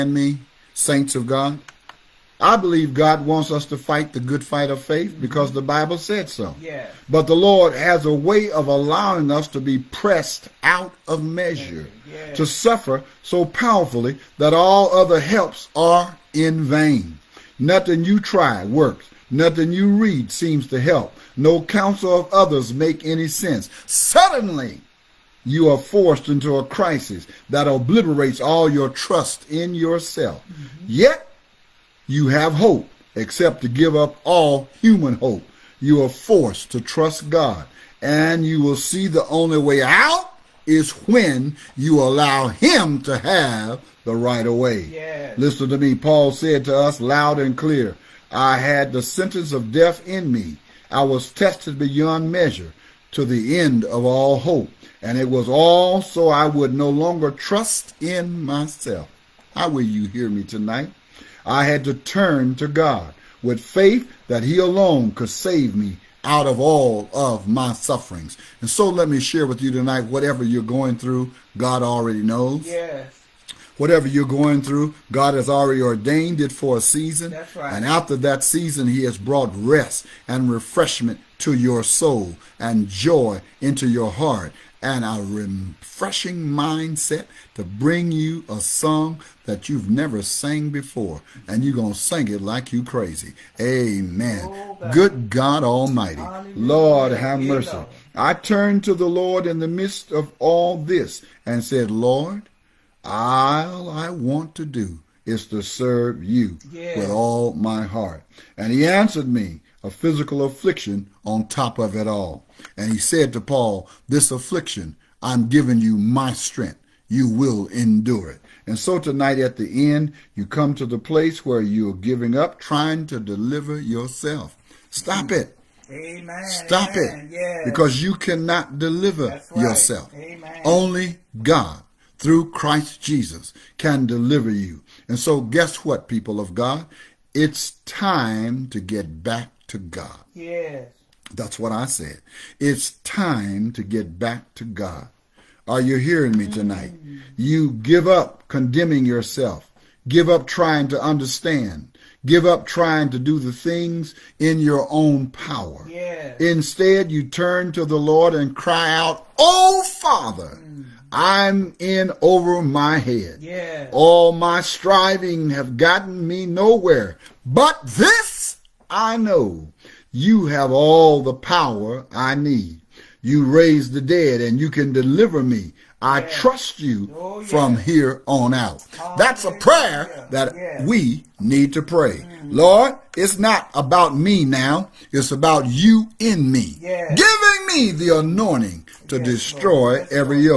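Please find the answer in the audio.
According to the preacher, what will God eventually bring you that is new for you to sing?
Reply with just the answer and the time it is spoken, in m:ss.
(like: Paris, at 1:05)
a song, at 1:28.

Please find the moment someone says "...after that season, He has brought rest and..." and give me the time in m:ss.
1:17.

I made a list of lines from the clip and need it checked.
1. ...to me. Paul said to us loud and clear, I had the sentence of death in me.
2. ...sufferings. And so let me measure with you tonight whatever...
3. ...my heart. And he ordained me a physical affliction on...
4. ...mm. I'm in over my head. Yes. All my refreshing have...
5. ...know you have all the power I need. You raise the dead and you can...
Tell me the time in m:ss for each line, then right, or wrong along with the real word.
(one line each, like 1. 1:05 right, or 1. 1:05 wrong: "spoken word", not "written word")
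1. 0:45 right
2. 1:07 wrong: "share", not "measure"
3. 1:47 wrong: "answered", not "ordained"
4. 2:40 wrong: "striving", not "refreshing"
5. 2:49 right.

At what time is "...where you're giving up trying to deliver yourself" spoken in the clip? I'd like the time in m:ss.
2:01.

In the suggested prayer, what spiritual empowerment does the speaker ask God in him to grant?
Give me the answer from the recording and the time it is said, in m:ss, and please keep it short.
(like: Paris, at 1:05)
the anointing, at 3:07.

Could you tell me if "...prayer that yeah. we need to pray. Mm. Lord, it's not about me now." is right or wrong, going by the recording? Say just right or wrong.
right.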